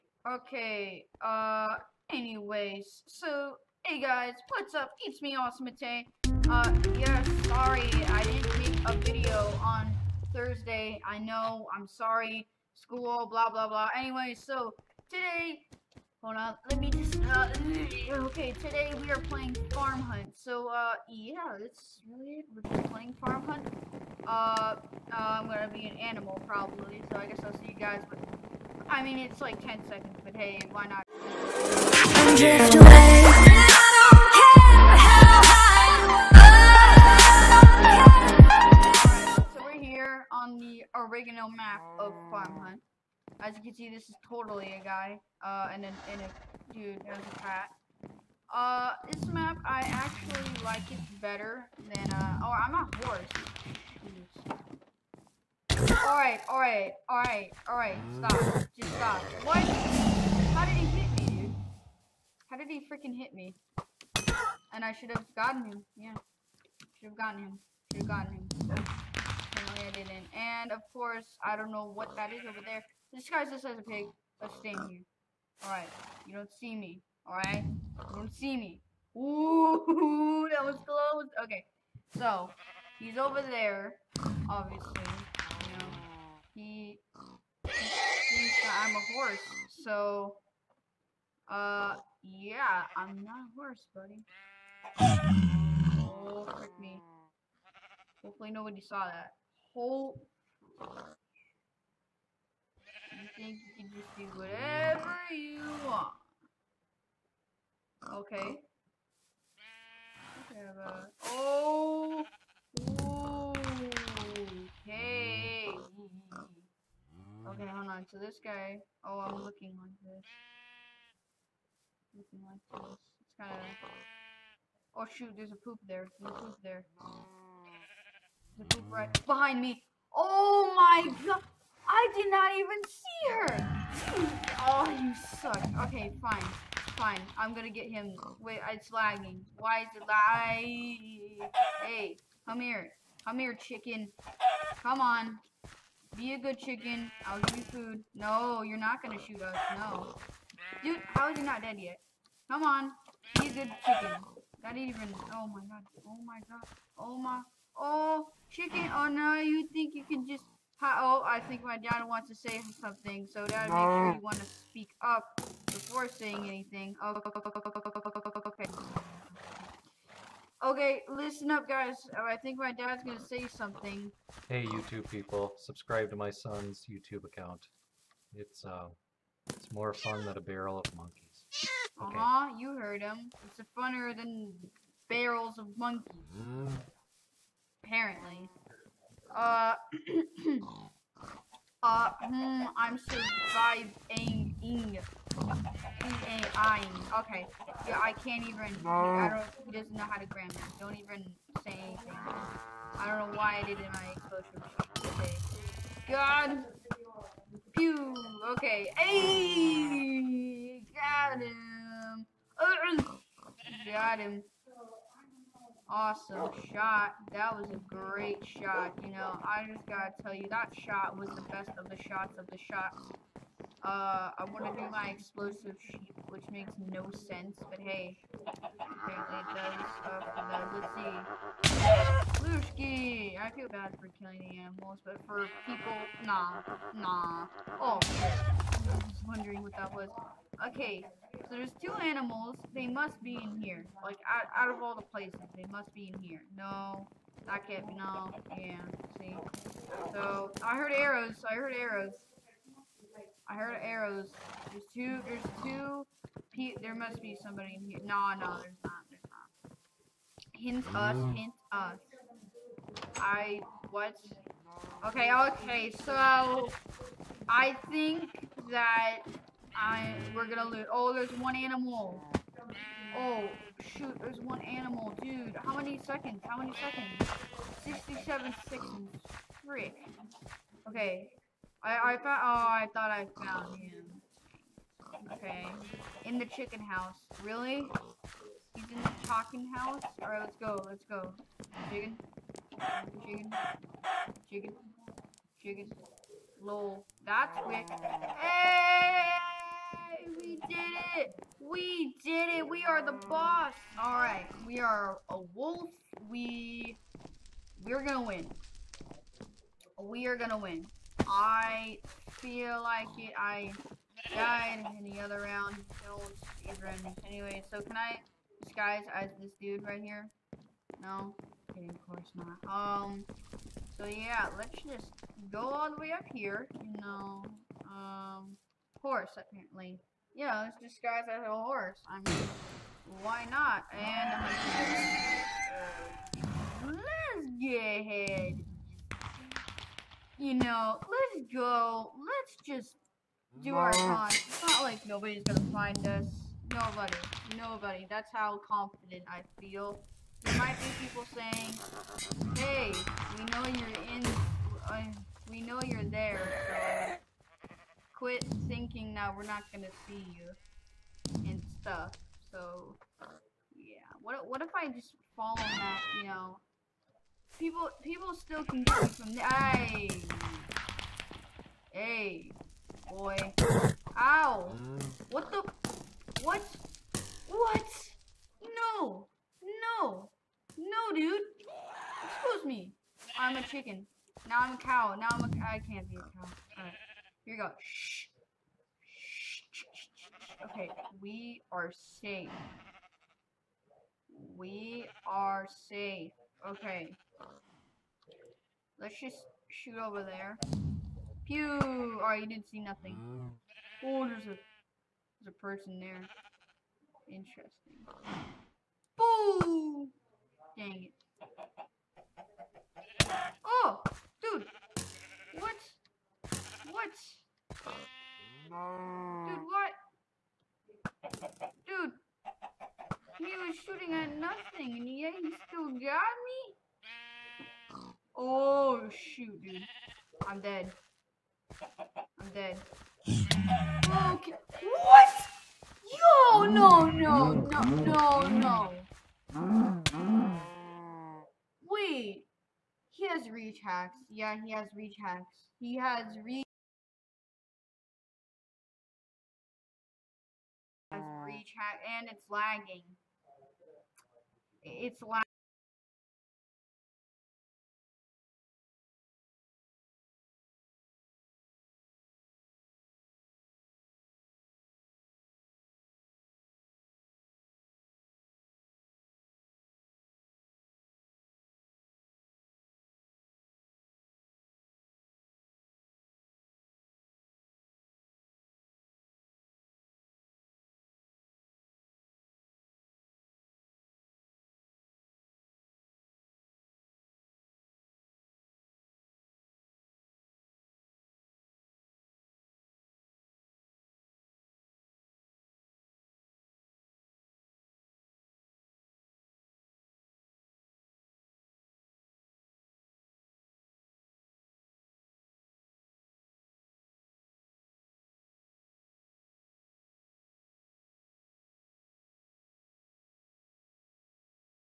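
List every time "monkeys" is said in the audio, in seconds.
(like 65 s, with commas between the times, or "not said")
180 s, 185 s.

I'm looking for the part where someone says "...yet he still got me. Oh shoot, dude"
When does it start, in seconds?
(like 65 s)
425 s.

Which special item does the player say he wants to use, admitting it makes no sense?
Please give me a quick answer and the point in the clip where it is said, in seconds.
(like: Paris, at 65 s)
Explosive sheep, at 225 s.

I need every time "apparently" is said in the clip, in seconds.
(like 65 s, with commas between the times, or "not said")
68 s, 187 s, 228 s, 329 s.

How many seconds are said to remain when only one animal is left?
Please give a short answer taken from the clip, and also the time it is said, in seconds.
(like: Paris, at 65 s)
67, at 277 s.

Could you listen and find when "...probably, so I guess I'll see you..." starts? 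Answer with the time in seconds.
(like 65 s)
26 s.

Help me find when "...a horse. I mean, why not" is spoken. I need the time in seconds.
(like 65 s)
331 s.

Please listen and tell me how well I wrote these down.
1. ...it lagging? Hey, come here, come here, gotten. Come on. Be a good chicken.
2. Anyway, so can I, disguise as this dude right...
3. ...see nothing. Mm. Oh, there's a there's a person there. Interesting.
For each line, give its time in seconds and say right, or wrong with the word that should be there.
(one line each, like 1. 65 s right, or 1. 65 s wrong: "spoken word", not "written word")
1. 139 s wrong: "chicken", not "gotten"
2. 317 s right
3. 402 s right.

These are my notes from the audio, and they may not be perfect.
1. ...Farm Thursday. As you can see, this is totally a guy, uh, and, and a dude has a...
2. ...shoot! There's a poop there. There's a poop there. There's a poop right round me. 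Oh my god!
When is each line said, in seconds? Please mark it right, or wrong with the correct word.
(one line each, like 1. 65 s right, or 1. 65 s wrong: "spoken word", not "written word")
1. 42 s wrong: "Hunt", not "Thursday"
2. 125 s wrong: "behind", not "round".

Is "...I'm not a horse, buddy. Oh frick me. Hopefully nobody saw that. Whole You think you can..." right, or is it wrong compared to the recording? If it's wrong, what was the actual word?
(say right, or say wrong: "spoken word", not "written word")
right.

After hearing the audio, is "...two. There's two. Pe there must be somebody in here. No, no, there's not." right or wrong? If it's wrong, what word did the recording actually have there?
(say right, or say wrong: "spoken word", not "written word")
right.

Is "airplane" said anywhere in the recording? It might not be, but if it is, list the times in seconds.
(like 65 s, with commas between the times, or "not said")
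not said.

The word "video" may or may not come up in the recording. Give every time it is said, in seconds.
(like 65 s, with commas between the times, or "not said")
8 s.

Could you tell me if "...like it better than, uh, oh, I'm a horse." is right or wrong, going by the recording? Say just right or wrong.
right.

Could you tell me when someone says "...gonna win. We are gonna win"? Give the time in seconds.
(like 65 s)
308 s.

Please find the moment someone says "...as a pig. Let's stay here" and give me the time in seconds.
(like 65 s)
73 s.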